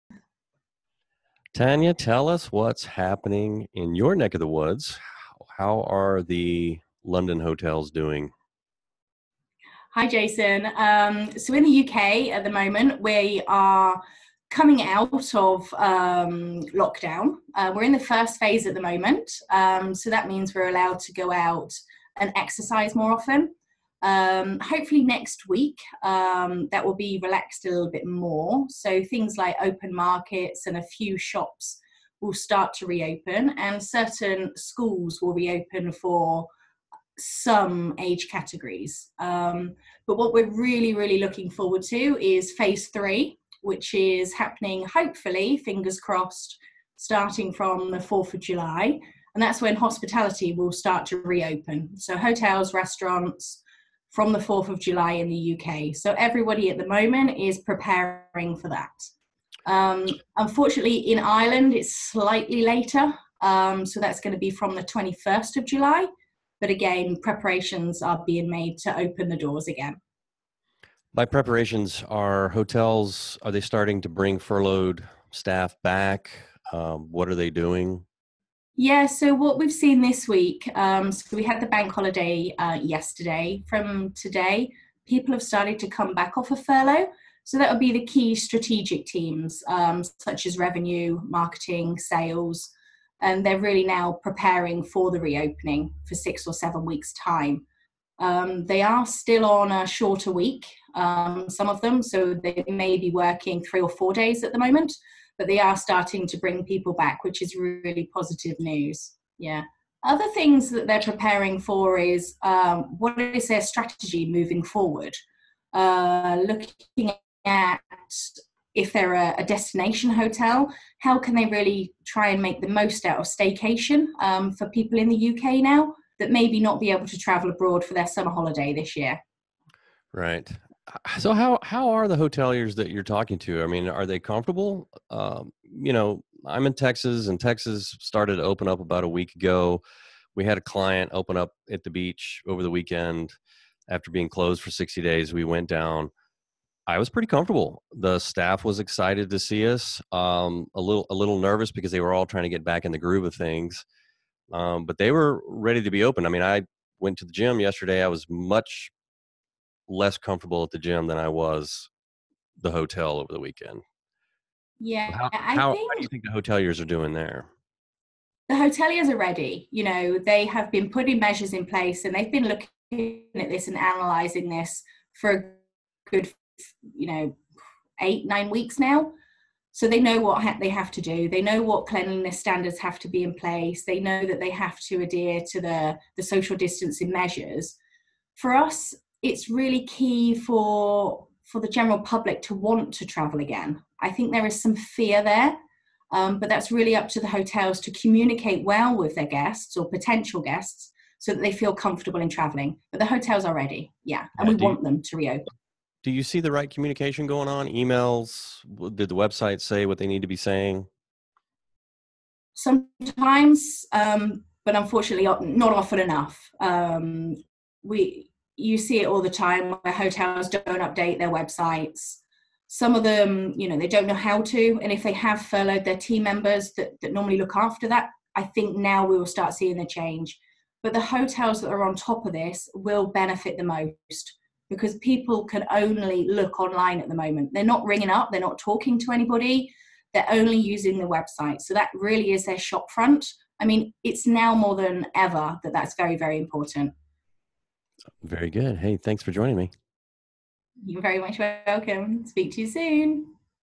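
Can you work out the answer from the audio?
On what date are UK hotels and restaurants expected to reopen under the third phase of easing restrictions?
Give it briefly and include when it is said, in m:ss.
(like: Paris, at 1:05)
4th of July, at 0:46.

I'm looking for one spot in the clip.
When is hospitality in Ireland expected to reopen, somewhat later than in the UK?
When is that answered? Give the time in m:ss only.
1:04.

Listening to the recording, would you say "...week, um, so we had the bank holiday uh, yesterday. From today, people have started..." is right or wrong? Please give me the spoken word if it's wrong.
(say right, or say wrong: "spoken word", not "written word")
right.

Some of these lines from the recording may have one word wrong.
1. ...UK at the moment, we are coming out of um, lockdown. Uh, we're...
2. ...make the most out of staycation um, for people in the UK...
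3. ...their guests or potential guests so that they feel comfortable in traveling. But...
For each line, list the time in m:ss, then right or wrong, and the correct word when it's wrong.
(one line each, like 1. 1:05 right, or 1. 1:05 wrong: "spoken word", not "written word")
1. 0:11 right
2. 2:02 right
3. 3:19 right.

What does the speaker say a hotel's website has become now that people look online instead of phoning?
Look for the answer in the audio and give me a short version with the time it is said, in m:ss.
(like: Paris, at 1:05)
Their shop front, at 4:02.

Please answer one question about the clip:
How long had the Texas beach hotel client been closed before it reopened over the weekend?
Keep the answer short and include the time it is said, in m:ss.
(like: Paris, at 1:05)
60 days, at 2:24.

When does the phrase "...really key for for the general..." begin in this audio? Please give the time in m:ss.
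3:09.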